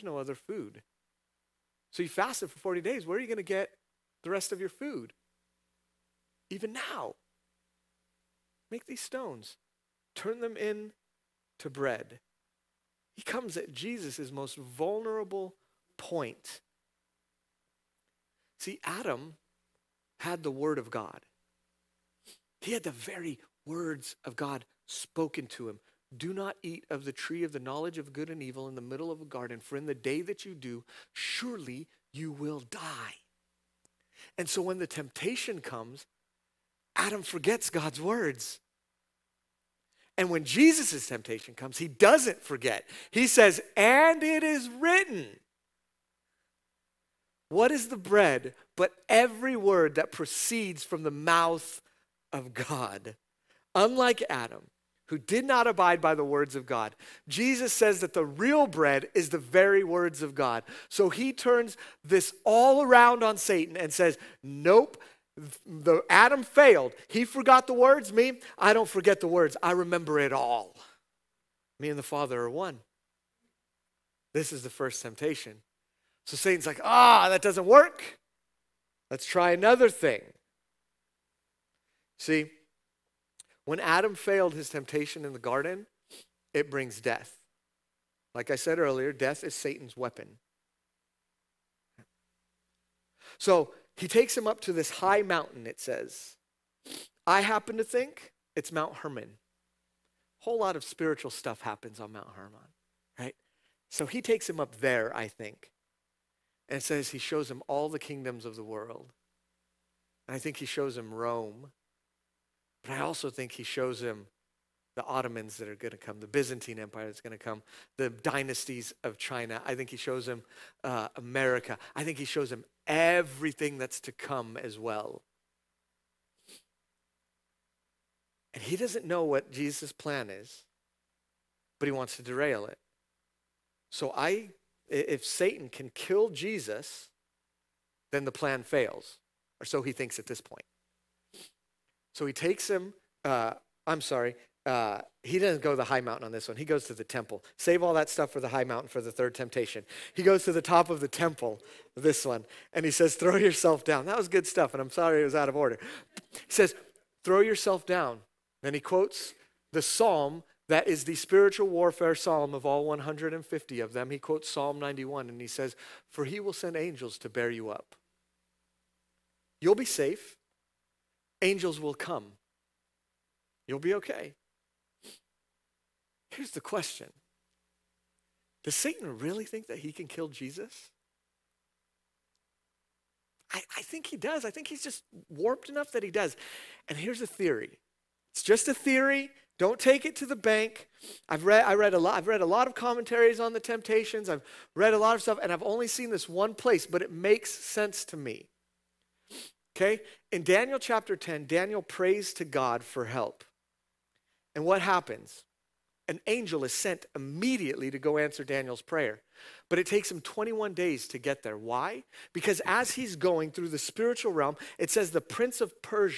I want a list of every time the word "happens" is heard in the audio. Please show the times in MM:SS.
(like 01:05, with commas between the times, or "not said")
01:37, 01:41, 03:24.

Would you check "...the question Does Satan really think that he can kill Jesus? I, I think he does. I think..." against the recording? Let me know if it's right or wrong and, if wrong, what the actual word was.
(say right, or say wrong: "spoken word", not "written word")
right.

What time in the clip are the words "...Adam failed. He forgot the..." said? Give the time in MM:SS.
01:06.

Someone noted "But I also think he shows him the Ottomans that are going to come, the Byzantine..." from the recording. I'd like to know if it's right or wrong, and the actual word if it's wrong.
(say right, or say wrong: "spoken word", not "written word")
right.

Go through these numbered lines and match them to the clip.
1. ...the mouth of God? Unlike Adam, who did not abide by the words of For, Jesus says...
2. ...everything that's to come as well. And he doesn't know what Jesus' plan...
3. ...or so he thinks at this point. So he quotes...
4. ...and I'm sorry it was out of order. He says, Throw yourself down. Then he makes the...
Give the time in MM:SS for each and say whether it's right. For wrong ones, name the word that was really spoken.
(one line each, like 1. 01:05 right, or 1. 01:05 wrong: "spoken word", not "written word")
1. 00:51 wrong: "God", not "For"
2. 02:02 right
3. 02:19 wrong: "takes", not "quotes"
4. 02:34 wrong: "quotes", not "makes".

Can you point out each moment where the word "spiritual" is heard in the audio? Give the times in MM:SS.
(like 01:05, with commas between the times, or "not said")
01:40, 02:41, 03:33.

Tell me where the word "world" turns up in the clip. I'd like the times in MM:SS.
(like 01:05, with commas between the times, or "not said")
01:48.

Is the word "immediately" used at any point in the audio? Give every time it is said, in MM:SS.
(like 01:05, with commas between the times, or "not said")
03:27.